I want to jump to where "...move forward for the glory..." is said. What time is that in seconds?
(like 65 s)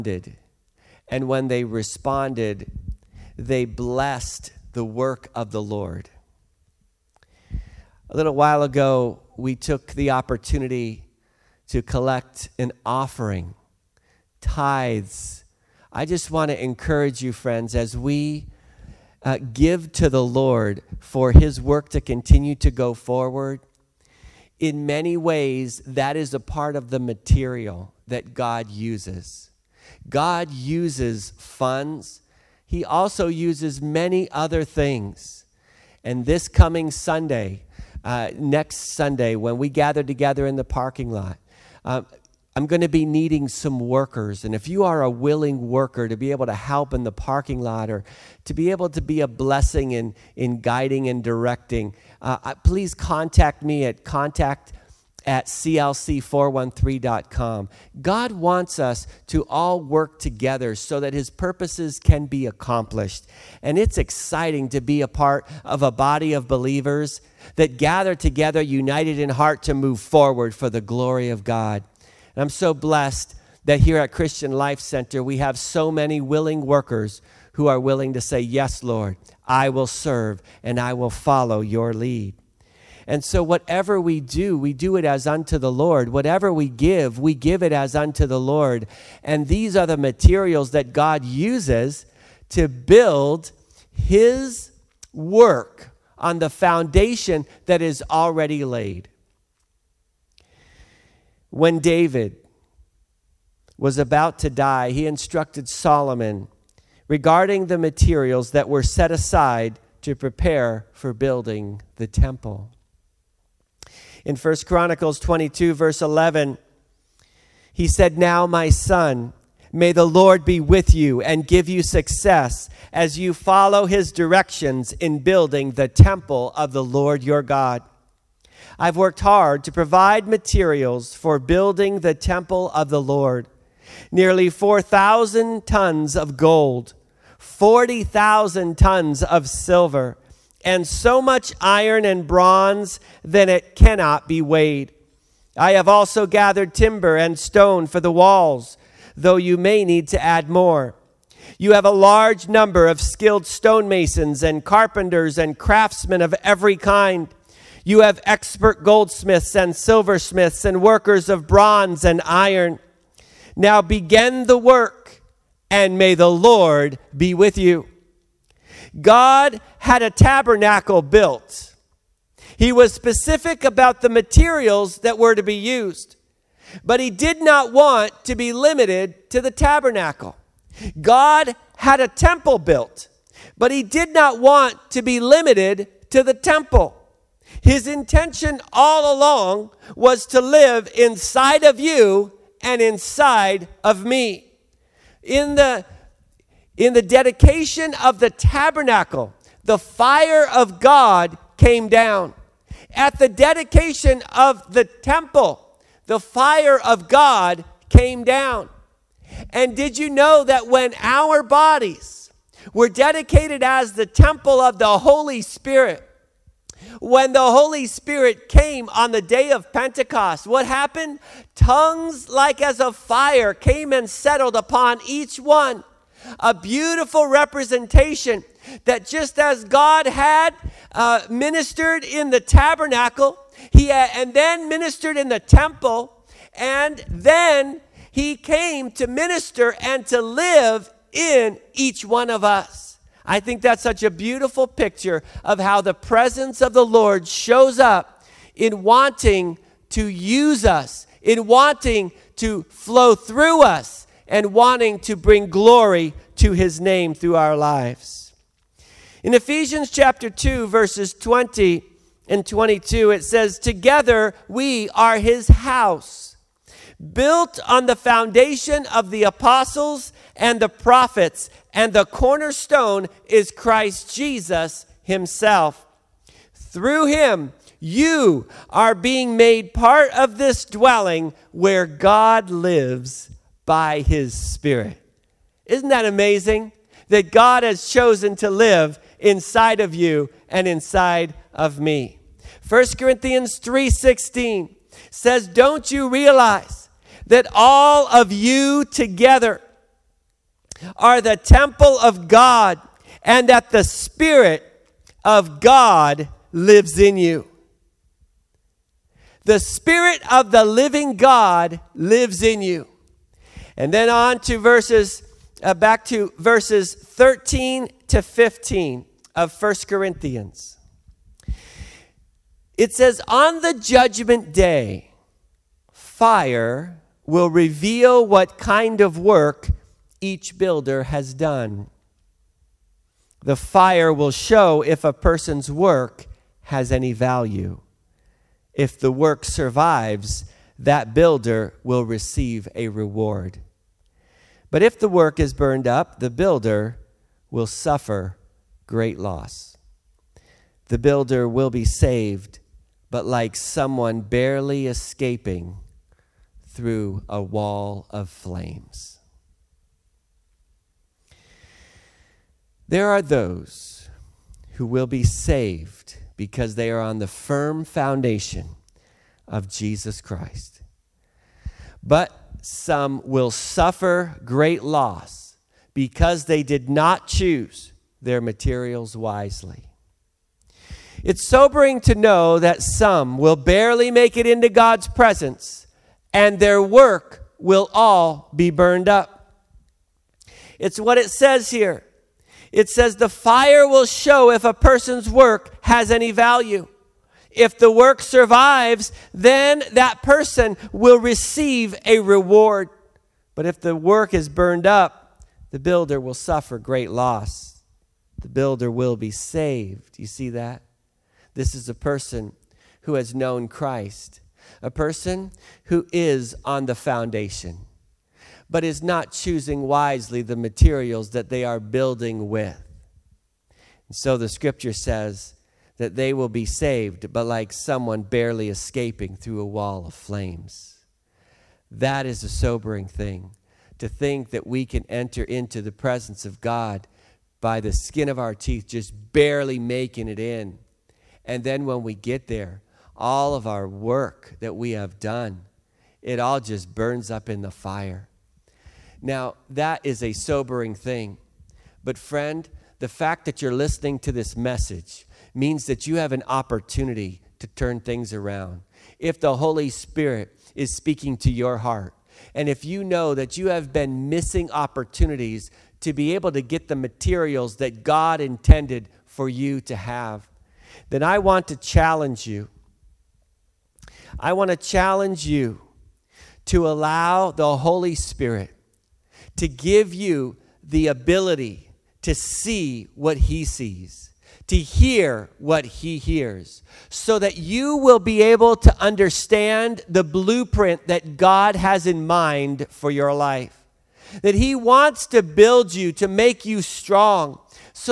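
69 s.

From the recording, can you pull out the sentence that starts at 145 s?
I have also gathered timber and stone for the walls, though you may need to add more.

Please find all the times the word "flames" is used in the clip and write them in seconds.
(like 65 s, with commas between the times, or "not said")
358 s, 430 s.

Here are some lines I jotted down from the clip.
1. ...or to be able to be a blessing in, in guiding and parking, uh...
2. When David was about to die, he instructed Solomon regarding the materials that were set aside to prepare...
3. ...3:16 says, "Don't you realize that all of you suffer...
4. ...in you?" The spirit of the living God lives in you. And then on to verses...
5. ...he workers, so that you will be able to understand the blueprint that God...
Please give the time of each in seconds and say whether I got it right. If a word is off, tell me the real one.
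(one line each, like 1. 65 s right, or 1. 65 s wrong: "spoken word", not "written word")
1. 47 s wrong: "directing", not "parking"
2. 101 s right
3. 293 s wrong: "together", not "suffer"
4. 306 s right
5. 485 s wrong: "hears", not "workers".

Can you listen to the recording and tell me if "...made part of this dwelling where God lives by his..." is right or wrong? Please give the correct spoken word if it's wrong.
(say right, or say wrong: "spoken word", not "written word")
right.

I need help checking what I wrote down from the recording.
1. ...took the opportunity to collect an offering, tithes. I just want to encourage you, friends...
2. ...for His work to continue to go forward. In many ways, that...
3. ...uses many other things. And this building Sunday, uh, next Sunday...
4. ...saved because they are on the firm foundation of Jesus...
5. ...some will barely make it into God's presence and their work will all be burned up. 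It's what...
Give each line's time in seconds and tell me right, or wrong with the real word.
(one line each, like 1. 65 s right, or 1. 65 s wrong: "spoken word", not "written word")
1. 9 s right
2. 20 s right
3. 33 s wrong: "coming", not "building"
4. 365 s right
5. 382 s right.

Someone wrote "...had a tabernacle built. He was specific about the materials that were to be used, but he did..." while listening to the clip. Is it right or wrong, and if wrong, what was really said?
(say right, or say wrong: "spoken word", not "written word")
right.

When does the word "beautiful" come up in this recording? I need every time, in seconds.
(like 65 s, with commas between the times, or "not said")
226 s, 244 s.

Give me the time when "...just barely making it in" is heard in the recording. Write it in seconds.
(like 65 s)
438 s.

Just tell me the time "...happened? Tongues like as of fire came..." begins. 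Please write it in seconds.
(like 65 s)
220 s.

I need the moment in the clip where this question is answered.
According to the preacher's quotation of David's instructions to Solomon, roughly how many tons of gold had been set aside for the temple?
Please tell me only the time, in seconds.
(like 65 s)
134 s.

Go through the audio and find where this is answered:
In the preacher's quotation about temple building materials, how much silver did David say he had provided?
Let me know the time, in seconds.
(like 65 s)
137 s.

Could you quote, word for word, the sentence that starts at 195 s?
In the in the dedication of the tabernacle, the fire of God came down.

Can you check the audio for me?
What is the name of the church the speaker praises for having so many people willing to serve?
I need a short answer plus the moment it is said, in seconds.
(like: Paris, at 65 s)
Christian Life Center, at 74 s.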